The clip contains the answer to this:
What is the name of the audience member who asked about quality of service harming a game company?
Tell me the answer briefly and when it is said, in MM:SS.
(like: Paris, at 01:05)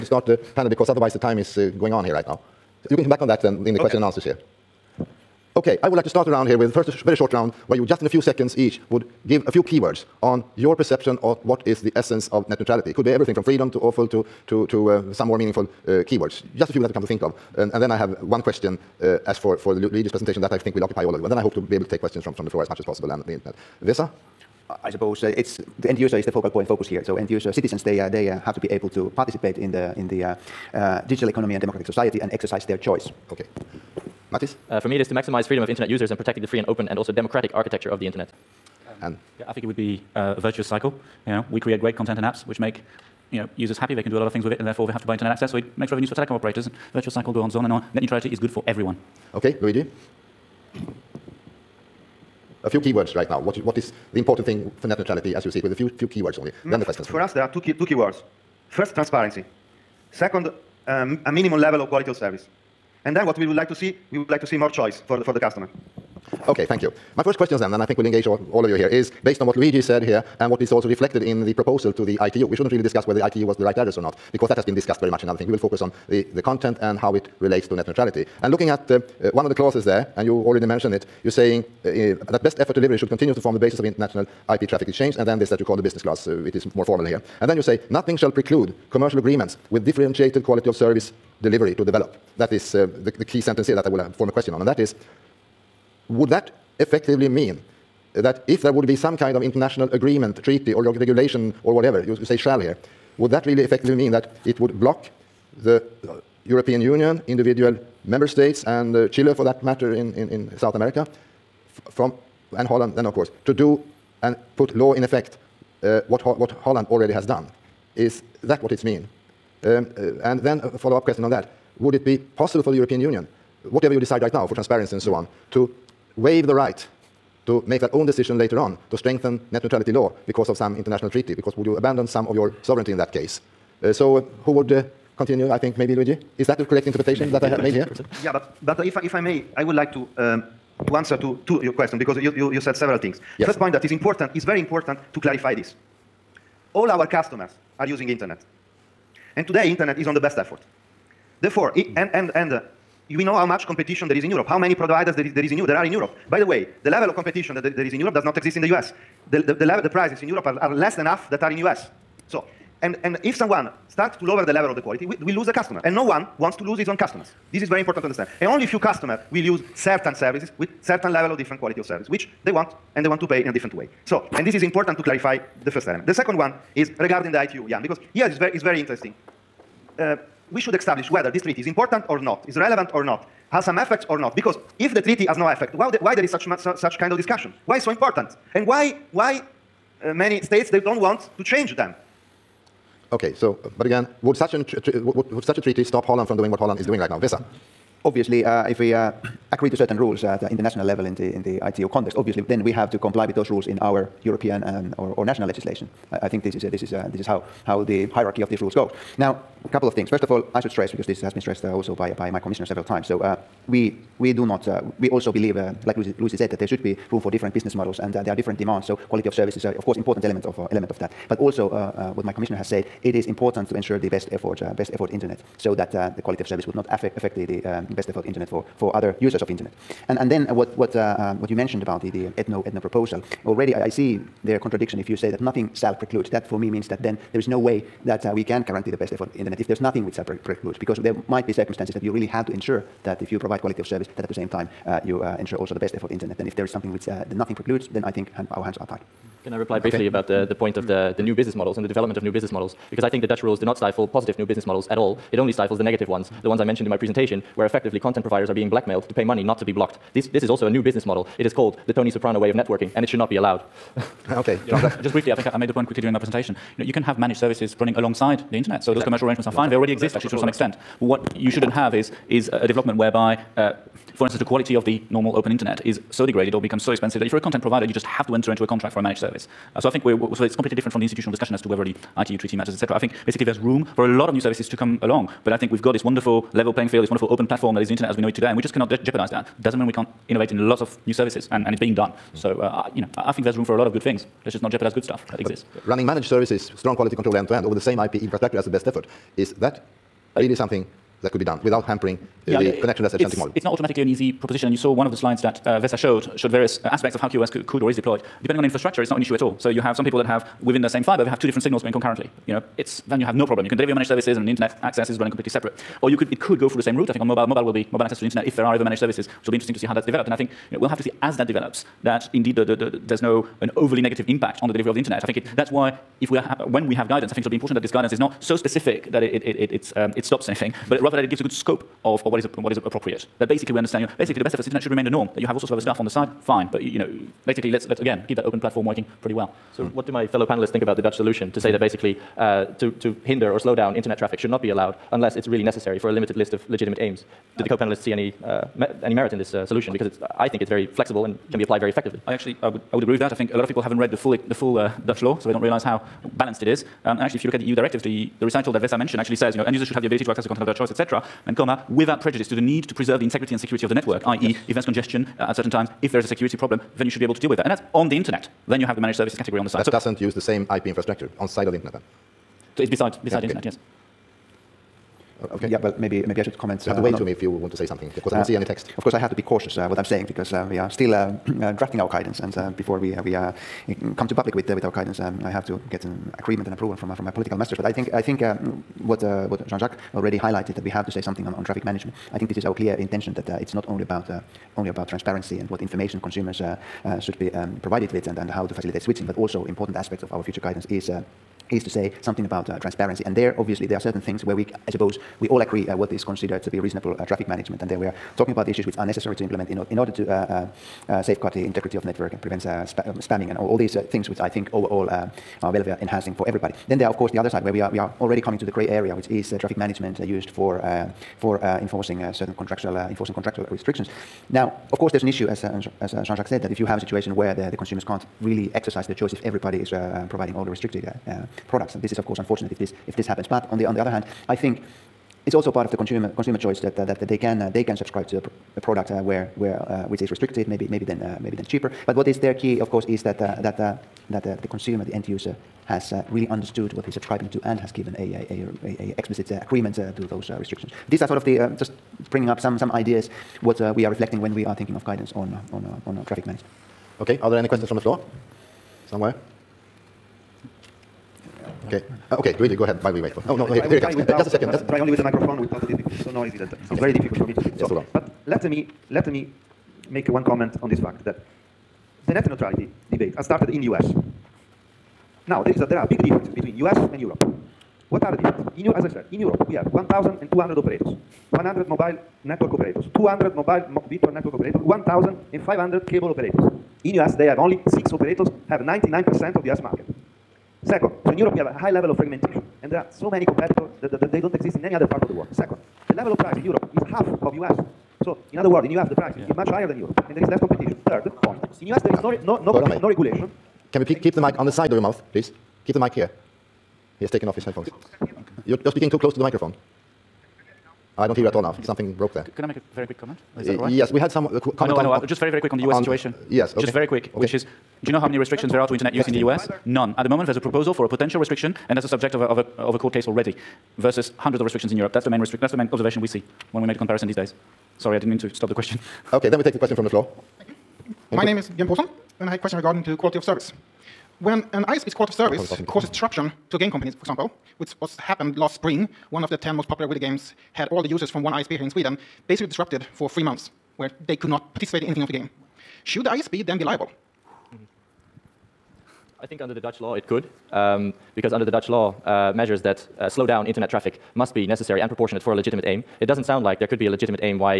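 Björn Posen, at 08:51.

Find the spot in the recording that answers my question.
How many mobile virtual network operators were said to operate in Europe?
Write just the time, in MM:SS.
08:03.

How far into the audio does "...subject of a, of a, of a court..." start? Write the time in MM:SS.
08:42.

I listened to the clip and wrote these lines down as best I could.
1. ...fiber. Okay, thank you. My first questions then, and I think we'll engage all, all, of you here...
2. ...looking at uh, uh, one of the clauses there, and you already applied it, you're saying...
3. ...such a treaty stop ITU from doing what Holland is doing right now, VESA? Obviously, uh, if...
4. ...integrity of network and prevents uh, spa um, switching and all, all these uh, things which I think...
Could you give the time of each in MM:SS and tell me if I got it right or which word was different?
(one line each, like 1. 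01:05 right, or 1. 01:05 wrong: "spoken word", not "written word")
1. 01:05 wrong: "customer", not "fiber"
2. 01:18 wrong: "mentioned", not "applied"
3. 03:15 wrong: "Holland", not "ITU"
4. 06:51 wrong: "spamming", not "switching".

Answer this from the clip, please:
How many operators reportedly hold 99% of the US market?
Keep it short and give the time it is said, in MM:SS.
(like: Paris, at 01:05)
6, at 08:07.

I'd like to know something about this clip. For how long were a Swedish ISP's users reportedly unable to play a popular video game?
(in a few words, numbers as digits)
3 months.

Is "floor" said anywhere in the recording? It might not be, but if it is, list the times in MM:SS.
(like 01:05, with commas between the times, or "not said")
00:22, 07:37, 08:50.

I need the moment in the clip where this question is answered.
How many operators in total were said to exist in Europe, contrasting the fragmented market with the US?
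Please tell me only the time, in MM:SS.
07:59.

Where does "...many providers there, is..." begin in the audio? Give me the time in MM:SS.
02:34.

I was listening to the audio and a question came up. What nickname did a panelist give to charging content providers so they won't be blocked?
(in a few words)
Tony Soprano way of networking.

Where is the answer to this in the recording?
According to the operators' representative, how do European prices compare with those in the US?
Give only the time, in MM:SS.
02:40.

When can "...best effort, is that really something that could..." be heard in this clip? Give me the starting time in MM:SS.
04:58.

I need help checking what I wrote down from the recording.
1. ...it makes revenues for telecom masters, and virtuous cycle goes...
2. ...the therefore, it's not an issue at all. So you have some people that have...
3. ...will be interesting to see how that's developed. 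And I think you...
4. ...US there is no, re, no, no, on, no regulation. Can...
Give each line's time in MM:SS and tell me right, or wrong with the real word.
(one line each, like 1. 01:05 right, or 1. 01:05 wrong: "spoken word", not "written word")
1. 00:45 wrong: "operators", not "masters"
2. 05:08 wrong: "infrastructure", not "therefore"
3. 05:19 right
4. 08:21 right.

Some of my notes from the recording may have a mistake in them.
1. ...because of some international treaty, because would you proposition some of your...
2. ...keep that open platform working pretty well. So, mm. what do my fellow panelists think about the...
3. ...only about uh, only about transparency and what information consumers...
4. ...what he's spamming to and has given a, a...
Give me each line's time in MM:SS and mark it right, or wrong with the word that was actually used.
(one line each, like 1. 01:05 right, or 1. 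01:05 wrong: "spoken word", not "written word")
1. 02:10 wrong: "abandon", not "proposition"
2. 05:38 right
3. 06:33 right
4. 07:26 wrong: "subscribing", not "spamming".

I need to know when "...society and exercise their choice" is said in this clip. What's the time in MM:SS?
00:31.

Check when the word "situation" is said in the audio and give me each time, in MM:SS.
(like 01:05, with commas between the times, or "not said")
07:06, 08:36.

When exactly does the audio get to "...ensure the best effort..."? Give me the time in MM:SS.
03:43.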